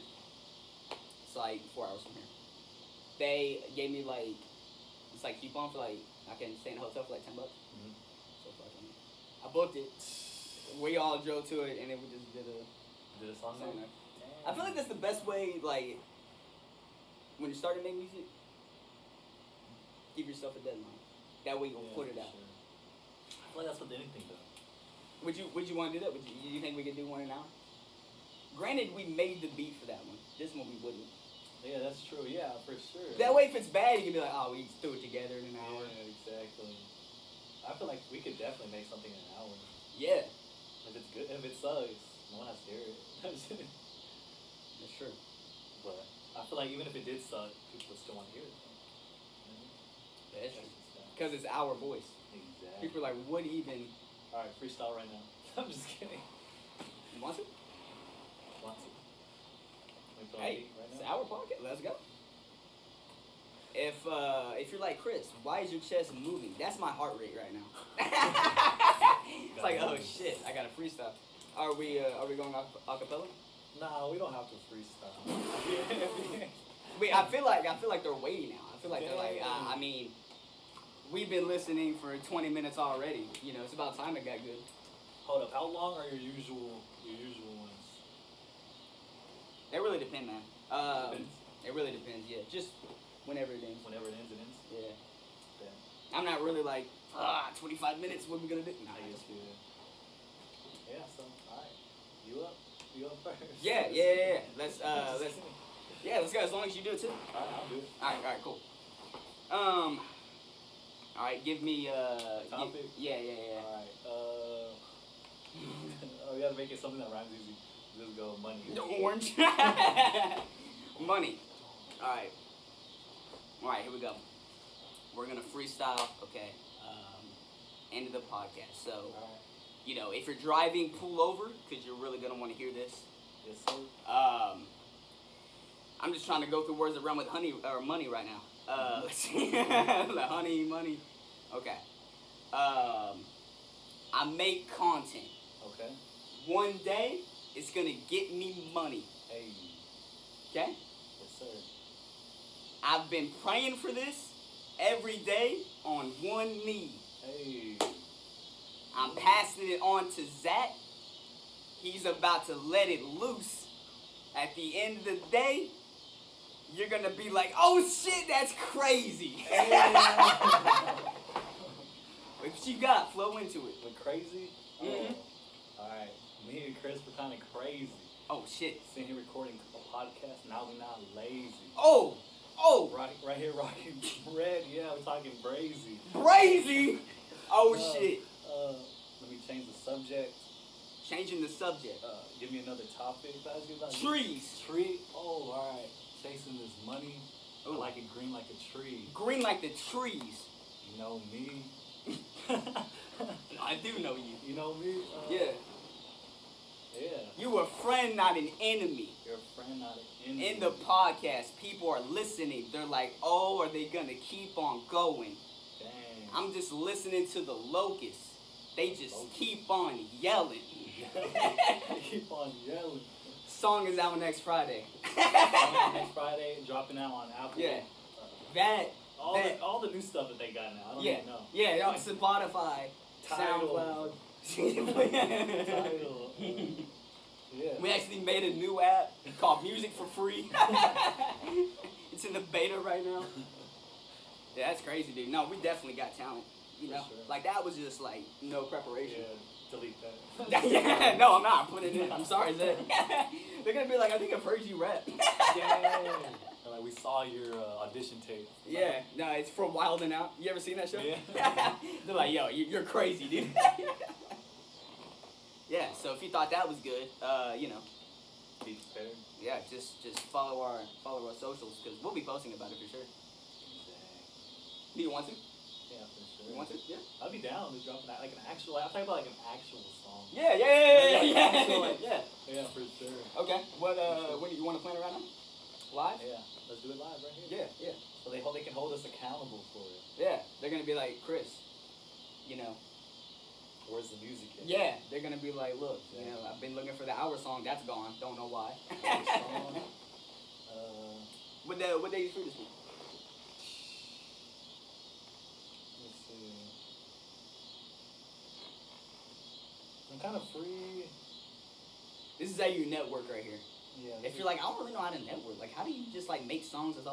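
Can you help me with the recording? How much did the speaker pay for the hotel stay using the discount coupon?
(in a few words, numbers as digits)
$10.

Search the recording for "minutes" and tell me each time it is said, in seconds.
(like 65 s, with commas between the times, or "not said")
82 s, 98 s.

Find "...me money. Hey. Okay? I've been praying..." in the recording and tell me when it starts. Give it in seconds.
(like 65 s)
148 s.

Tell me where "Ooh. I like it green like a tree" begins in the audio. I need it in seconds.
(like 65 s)
197 s.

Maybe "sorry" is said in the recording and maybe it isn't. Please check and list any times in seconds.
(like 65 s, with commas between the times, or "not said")
252 s.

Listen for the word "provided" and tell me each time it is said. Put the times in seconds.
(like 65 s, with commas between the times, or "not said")
not said.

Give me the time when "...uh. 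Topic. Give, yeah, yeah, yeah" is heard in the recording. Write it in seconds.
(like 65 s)
111 s.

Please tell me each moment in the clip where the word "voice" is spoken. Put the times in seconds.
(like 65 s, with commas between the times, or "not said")
51 s.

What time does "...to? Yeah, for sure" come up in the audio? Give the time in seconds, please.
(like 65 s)
275 s.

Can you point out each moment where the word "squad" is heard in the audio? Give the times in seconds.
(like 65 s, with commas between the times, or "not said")
not said.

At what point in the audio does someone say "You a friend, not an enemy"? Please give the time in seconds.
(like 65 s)
207 s.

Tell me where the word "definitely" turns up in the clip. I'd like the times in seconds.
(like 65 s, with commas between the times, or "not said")
38 s, 245 s.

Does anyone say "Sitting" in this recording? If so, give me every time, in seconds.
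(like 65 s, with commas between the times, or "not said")
178 s.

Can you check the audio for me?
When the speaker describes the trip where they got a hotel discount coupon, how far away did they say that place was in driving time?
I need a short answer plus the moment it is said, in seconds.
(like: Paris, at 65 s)
4 hours, at 1 s.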